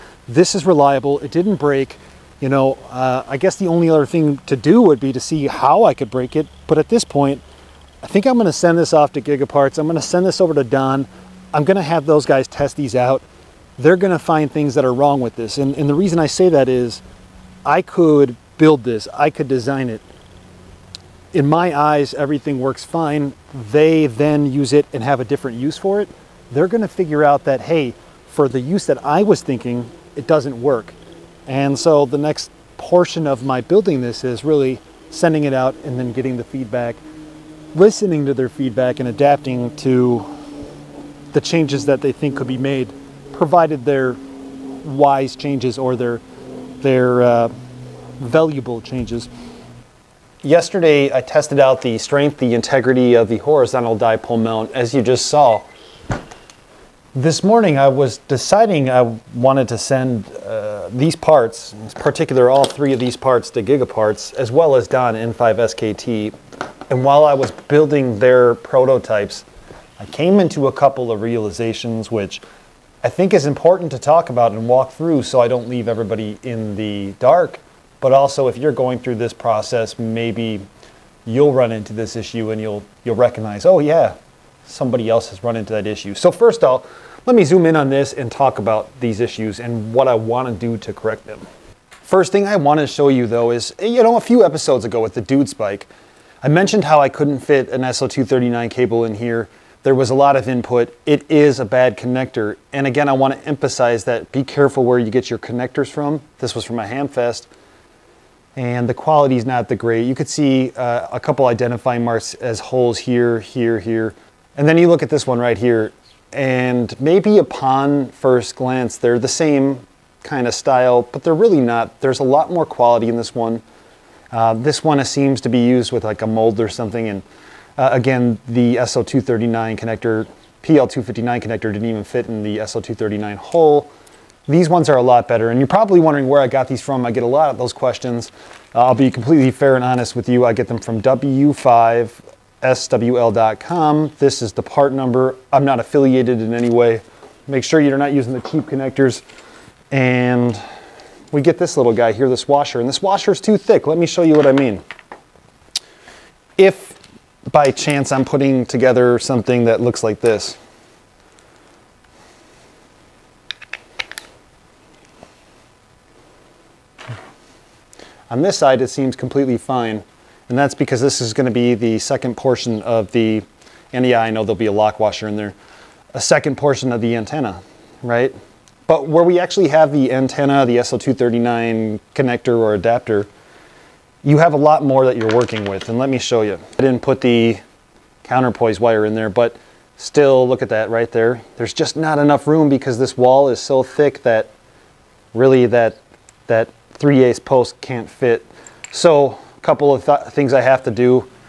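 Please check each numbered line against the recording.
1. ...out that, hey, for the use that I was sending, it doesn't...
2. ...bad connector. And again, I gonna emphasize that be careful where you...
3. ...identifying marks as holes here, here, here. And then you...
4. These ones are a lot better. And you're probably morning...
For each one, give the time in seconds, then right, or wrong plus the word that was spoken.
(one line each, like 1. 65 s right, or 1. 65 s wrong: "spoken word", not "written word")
1. 27 s wrong: "thinking", not "sending"
2. 101 s wrong: "wanna", not "gonna"
3. 111 s right
4. 134 s wrong: "wondering", not "morning".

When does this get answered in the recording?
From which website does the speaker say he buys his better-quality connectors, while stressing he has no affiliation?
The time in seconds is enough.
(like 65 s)
141 s.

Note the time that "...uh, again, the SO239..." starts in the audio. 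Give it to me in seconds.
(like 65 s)
127 s.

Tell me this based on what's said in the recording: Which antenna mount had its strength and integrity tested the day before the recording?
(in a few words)
horizontal dipole mount.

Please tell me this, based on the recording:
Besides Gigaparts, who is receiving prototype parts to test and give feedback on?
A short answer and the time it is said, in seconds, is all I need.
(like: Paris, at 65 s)
Don N5SKT, at 64 s.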